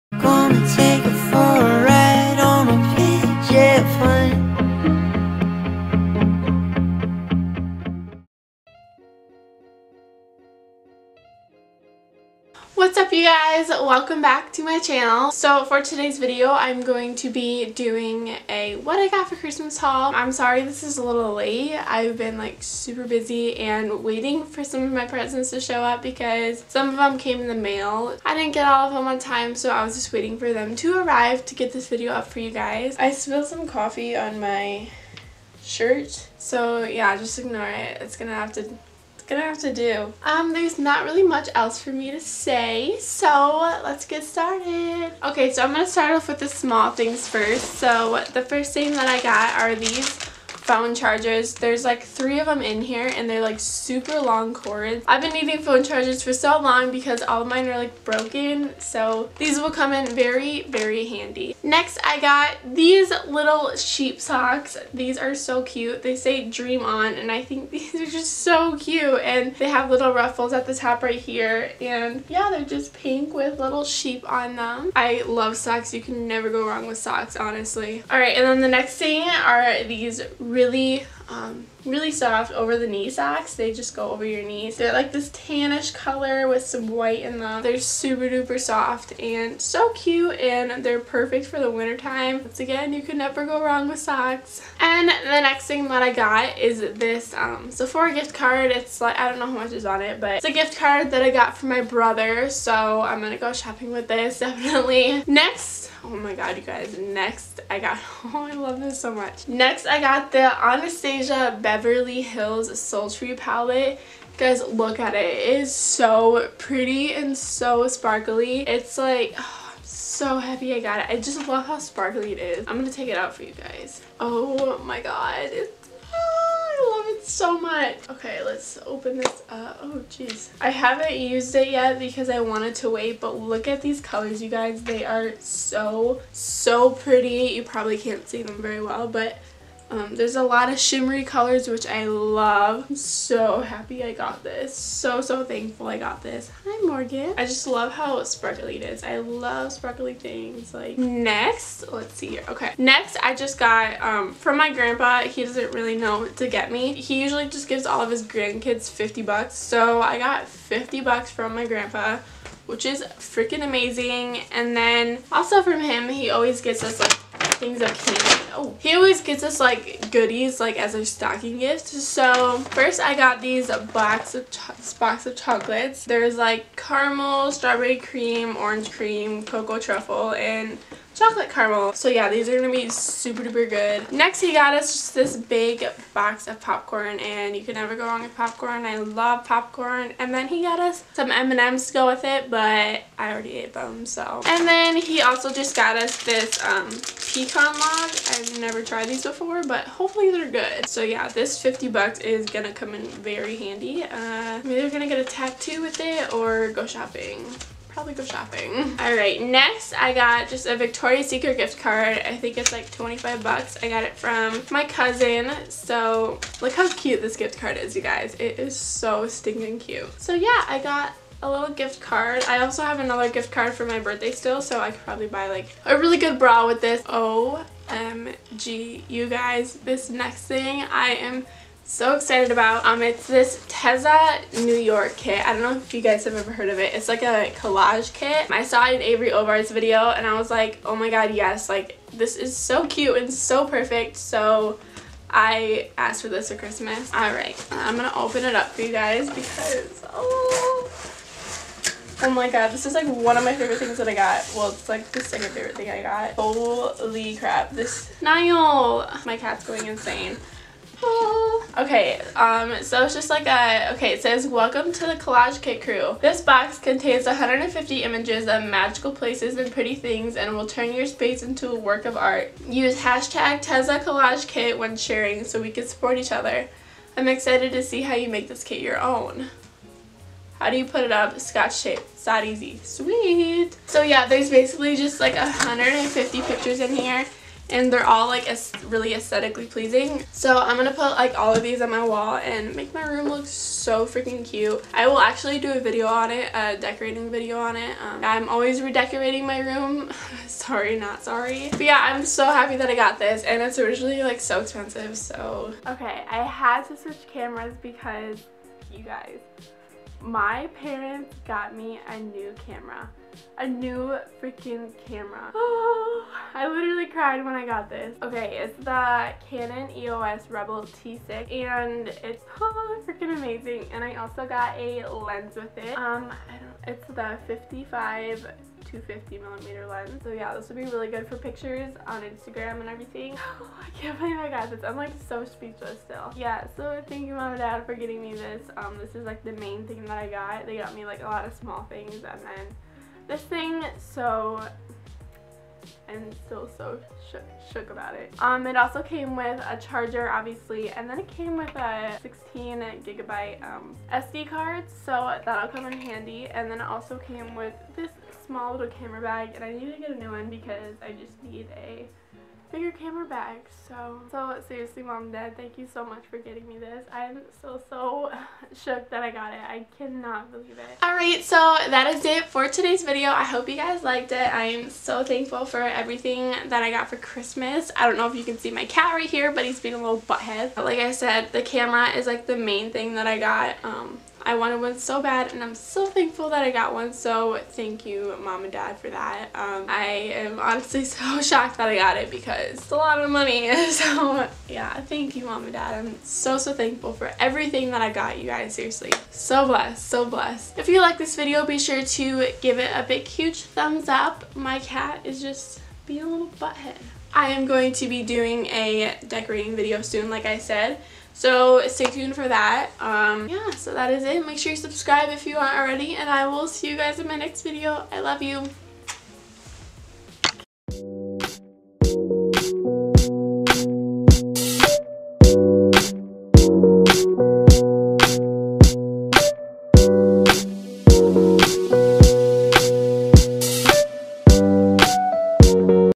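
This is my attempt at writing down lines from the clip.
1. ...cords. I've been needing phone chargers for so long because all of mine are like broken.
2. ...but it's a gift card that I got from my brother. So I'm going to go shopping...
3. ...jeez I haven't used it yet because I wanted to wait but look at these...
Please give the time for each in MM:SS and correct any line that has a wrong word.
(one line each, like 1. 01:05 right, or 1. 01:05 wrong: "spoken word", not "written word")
1. 00:54 right
2. 01:40 right
3. 02:10 right.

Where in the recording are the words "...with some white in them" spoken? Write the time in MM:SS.
01:26.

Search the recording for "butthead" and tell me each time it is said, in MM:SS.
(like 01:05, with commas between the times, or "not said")
06:20, 06:46.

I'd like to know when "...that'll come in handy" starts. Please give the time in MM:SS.
05:55.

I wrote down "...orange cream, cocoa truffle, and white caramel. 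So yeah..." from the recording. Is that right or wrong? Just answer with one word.
wrong.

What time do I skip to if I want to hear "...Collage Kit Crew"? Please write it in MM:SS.
04:25.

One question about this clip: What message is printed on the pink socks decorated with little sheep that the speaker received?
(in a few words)
dream on.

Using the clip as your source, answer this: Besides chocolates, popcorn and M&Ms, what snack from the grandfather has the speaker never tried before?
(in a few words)
pecan log.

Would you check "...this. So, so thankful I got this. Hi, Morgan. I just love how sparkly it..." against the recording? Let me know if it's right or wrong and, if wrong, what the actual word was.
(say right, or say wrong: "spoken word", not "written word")
right.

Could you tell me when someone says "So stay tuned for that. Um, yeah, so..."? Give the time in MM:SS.
06:51.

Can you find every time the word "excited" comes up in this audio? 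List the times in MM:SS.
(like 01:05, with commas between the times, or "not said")
03:52, 04:37.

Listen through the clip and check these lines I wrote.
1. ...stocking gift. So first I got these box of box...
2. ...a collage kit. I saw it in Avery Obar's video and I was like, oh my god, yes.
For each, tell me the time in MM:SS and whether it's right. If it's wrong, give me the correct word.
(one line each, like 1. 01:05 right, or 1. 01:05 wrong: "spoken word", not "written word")
1. 02:51 right
2. 03:57 right.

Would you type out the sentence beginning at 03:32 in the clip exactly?
I think it's like 25 bucks.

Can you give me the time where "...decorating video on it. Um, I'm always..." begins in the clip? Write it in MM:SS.
04:56.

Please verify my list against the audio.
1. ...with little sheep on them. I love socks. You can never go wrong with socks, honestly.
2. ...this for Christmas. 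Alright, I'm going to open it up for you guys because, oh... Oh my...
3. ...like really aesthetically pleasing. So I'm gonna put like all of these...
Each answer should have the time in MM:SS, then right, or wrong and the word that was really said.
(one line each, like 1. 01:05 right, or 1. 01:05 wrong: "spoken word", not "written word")
1. 01:13 right
2. 04:06 right
3. 04:48 right.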